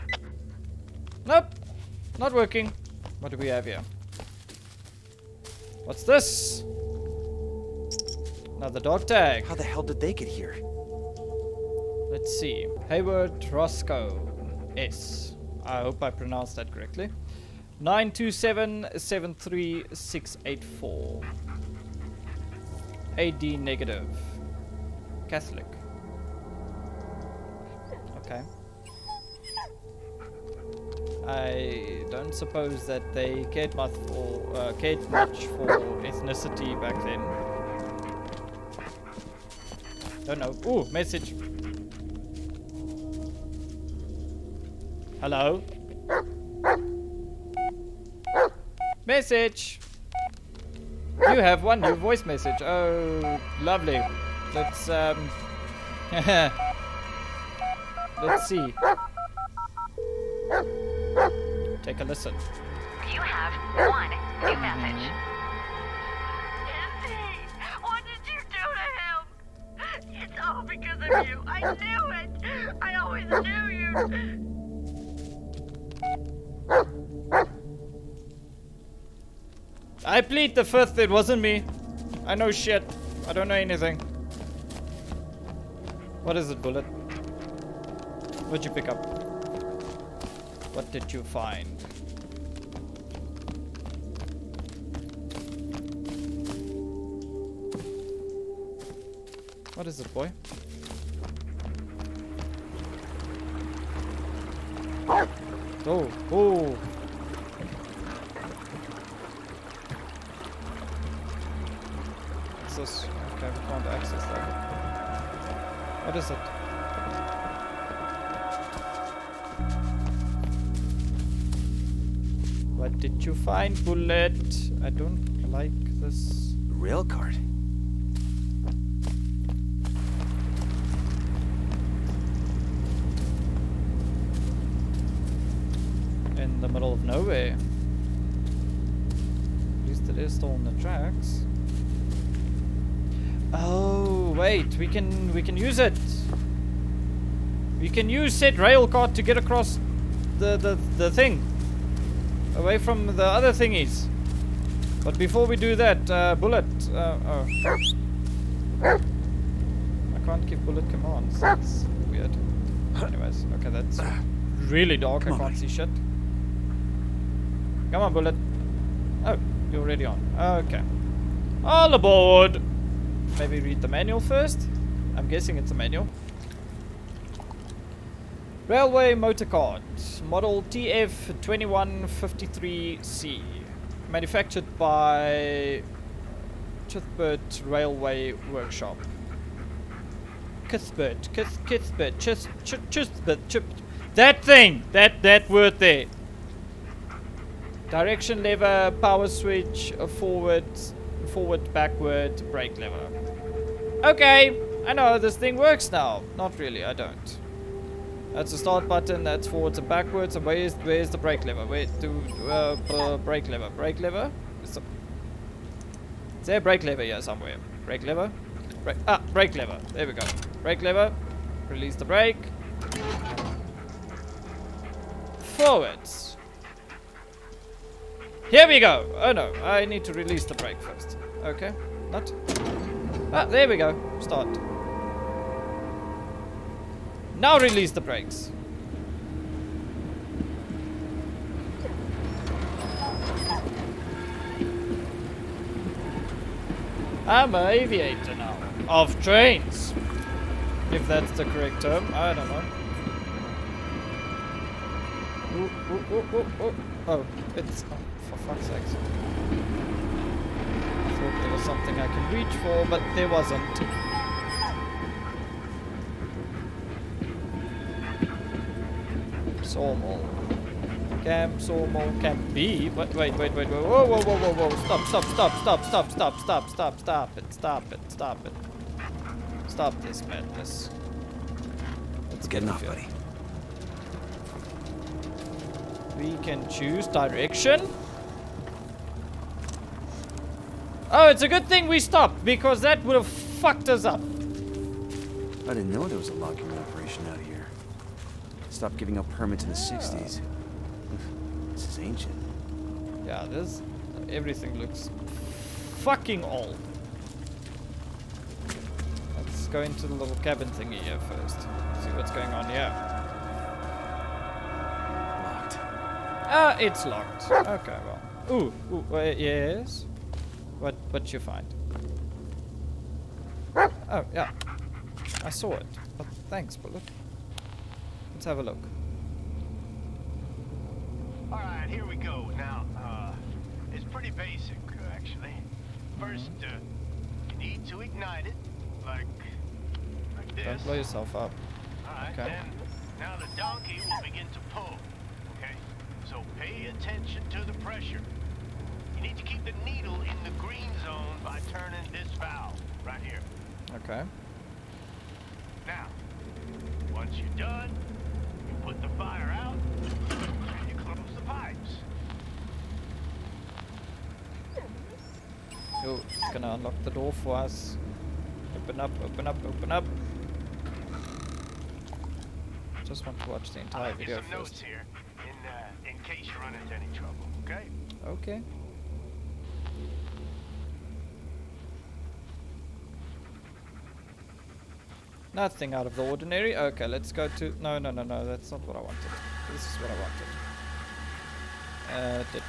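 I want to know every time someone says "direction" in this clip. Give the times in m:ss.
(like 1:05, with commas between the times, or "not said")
3:17, 4:47.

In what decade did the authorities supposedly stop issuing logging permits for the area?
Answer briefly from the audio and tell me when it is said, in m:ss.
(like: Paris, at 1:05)
the 60s, at 4:59.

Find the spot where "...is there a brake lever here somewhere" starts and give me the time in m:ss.
3:36.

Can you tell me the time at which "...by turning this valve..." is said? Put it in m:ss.
5:51.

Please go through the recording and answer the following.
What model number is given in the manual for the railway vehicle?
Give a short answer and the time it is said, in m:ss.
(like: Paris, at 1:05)
TF2153C, at 3:00.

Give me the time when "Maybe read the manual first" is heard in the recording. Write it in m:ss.
2:53.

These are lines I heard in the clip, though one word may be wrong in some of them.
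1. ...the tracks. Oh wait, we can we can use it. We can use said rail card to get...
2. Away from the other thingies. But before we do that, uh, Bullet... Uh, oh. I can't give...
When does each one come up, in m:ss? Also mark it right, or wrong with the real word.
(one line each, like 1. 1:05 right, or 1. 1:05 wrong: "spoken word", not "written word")
1. 2:20 right
2. 2:32 right.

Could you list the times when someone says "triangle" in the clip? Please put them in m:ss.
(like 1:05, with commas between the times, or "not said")
not said.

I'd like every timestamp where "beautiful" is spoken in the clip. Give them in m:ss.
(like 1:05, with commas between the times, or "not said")
not said.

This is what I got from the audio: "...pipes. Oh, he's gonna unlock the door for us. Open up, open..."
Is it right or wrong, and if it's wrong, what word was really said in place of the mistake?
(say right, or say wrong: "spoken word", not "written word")
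right.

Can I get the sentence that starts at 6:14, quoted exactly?
Notes here in, uh, in case you run into any trouble, okay?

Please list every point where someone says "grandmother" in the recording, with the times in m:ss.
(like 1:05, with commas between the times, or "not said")
not said.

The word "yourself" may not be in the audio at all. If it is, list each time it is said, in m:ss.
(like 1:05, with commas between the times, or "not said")
5:40.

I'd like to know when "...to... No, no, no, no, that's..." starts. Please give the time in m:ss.
6:27.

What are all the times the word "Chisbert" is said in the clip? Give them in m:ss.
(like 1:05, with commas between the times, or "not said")
3:12.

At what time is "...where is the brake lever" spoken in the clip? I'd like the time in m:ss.
3:30.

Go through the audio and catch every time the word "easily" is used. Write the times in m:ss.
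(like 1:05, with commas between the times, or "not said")
not said.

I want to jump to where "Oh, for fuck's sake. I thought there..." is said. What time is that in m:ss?
4:17.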